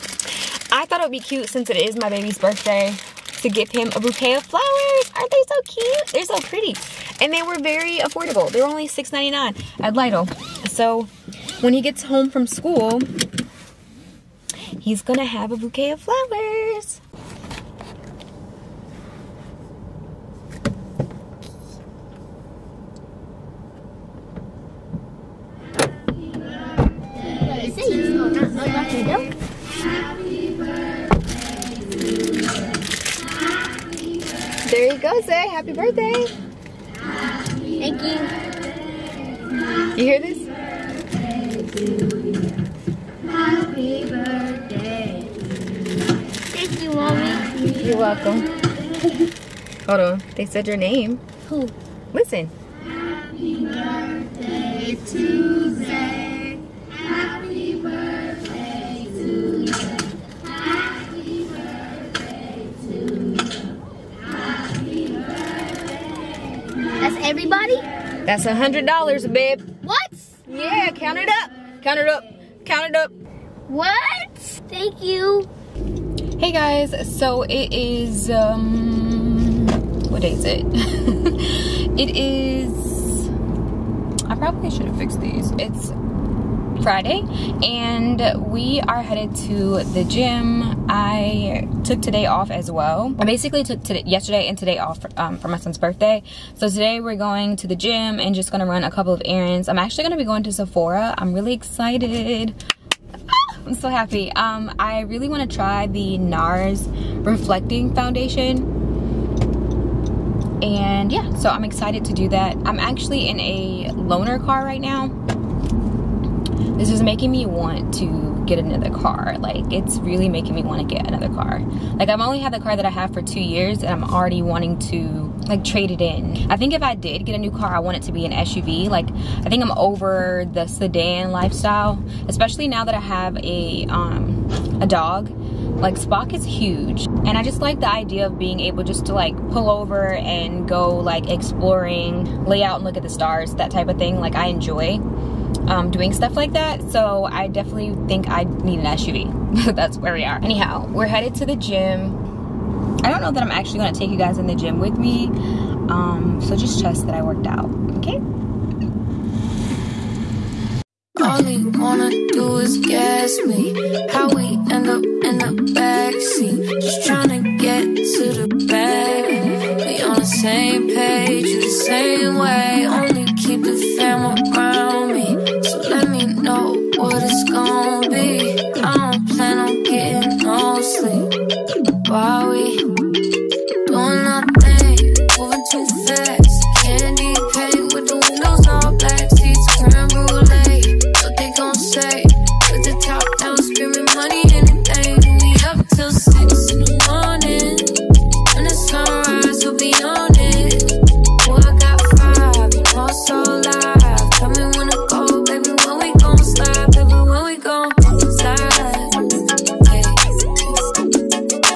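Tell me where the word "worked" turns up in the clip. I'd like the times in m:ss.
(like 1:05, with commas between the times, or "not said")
2:37.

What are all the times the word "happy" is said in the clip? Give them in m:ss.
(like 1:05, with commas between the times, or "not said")
0:35, 0:43, 0:52, 1:43.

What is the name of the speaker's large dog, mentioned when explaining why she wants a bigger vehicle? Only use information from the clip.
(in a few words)
Spock.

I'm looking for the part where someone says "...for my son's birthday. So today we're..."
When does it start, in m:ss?
1:35.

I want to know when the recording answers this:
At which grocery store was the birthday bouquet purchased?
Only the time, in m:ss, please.
0:09.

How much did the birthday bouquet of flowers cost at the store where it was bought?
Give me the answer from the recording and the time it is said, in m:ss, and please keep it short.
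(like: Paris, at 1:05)
$6.99, at 0:08.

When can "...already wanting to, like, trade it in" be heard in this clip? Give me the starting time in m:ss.
2:04.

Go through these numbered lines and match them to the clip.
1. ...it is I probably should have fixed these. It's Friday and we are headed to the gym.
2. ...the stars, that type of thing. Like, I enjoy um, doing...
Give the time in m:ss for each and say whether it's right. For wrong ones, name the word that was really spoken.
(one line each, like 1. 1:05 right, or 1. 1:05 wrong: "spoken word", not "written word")
1. 1:21 right
2. 2:23 right.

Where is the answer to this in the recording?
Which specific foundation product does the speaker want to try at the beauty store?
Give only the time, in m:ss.
1:46.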